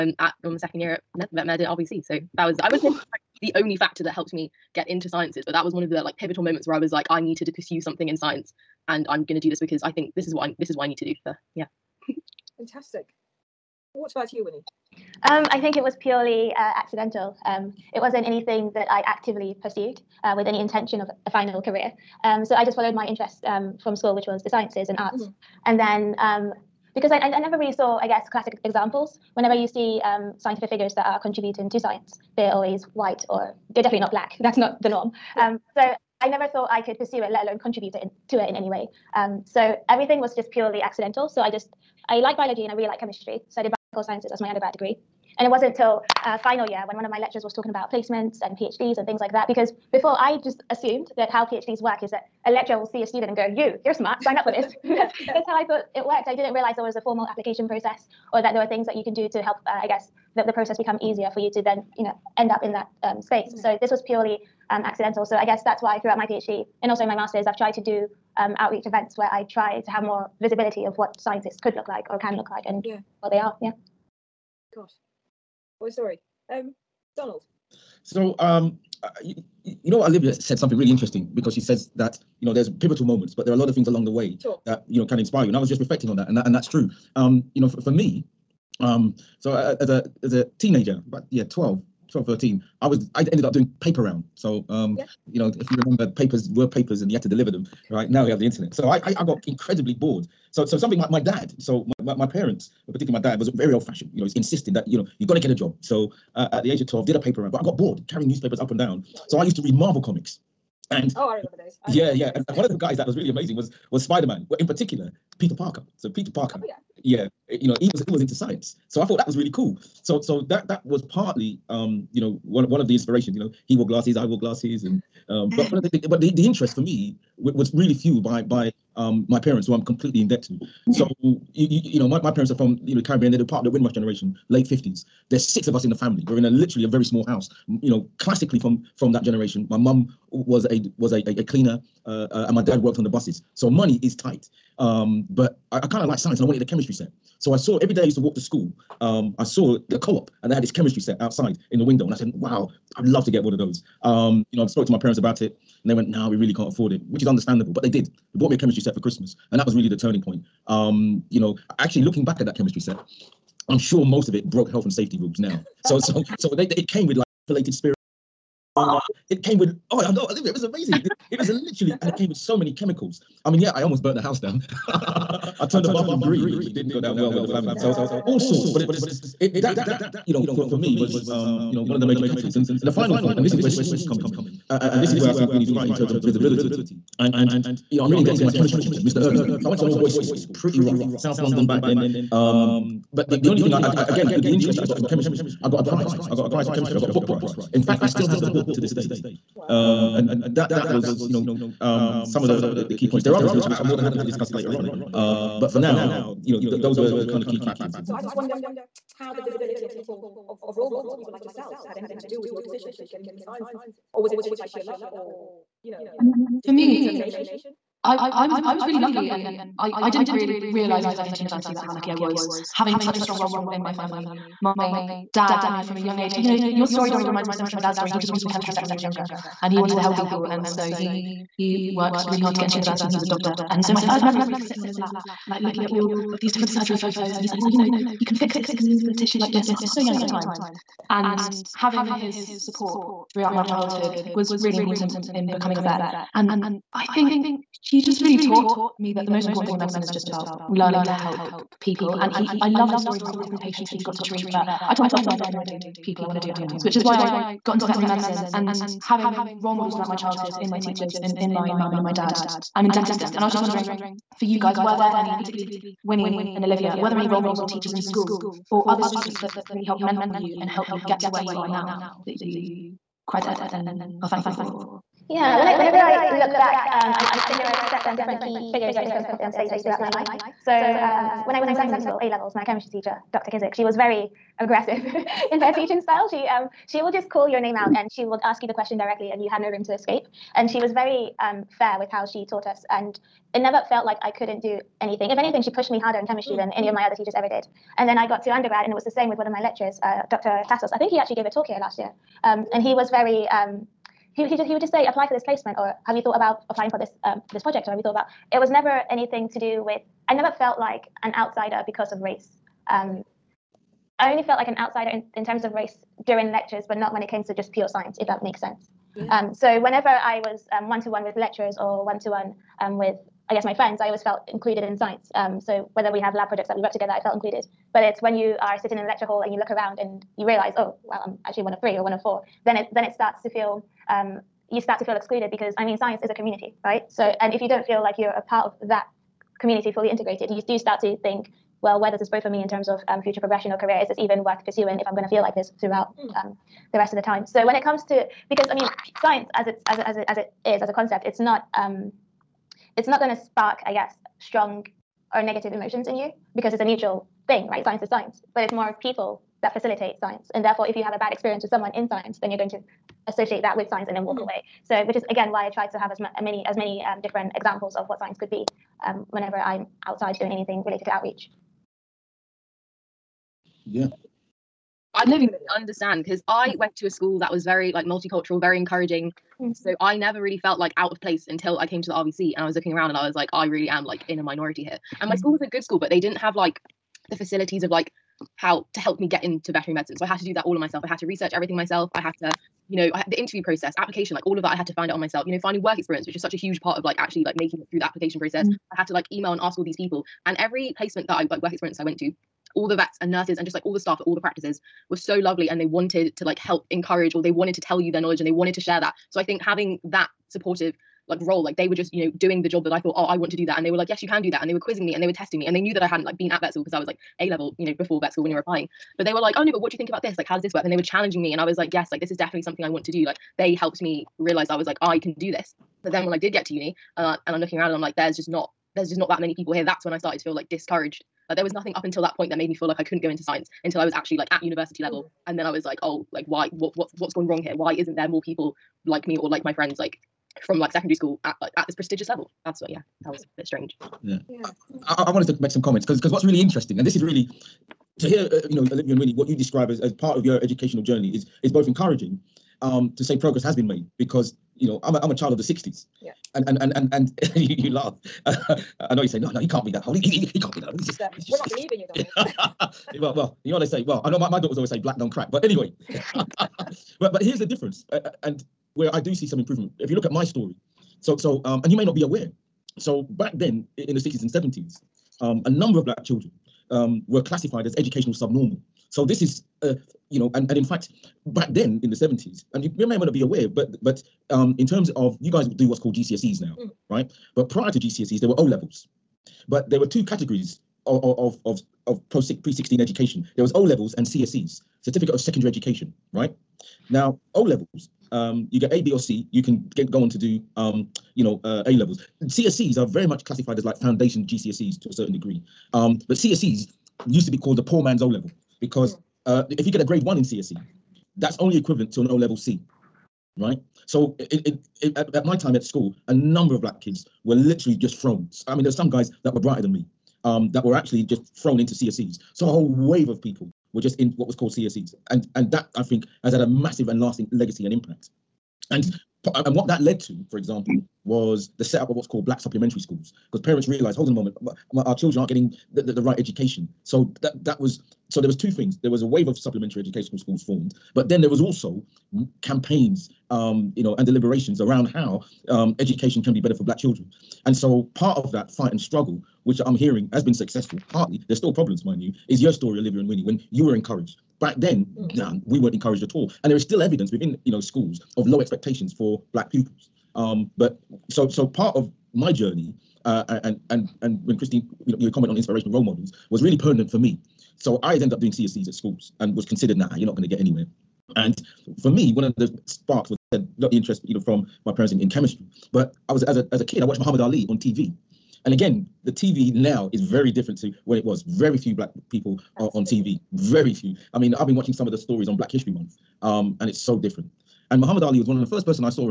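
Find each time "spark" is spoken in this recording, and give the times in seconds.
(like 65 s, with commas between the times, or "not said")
353 s, 572 s.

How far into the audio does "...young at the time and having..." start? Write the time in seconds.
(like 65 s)
239 s.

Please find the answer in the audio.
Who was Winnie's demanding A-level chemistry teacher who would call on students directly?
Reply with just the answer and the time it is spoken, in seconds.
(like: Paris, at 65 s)
Dr. Kizik, at 283 s.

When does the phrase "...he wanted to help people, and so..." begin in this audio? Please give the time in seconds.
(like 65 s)
229 s.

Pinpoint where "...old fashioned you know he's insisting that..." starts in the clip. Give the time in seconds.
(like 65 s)
103 s.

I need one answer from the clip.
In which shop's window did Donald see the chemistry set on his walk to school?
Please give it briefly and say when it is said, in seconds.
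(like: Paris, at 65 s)
The co-op, at 149 s.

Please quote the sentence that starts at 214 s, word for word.
Or was it by sheer luck or, you know, um, for me, determination?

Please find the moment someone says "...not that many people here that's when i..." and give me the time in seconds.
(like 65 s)
429 s.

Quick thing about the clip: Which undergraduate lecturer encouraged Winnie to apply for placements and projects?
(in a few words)
Dr. Tassos.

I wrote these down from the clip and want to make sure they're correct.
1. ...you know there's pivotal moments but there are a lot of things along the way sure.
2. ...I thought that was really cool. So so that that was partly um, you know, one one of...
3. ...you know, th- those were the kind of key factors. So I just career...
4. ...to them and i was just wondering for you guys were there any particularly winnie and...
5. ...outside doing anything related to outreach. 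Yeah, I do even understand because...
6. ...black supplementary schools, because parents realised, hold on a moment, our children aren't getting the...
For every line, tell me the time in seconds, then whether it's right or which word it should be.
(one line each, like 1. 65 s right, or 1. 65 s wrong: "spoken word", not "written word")
1. 82 s right
2. 119 s right
3. 206 s wrong: "wonder", not "career"
4. 263 s right
5. 370 s right
6. 532 s right.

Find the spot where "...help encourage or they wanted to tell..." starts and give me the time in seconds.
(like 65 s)
406 s.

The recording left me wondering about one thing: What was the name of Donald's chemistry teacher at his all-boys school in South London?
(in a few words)
Mr. Irving.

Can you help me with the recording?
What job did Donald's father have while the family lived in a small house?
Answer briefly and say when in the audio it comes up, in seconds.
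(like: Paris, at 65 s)
Worked on the buses, at 142 s.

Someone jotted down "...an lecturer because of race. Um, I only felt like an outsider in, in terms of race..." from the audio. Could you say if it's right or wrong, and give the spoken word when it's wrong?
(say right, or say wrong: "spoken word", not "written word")
wrong: "outsider", not "lecturer".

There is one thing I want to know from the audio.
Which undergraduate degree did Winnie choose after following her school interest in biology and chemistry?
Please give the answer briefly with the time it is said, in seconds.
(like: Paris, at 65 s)
Biological sciences, at 43 s.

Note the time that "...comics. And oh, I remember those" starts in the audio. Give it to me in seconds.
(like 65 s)
110 s.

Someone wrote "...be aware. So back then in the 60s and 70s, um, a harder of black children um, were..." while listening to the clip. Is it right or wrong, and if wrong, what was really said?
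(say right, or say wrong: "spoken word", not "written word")
wrong: "number", not "harder".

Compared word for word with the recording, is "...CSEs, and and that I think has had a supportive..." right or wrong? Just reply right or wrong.
wrong.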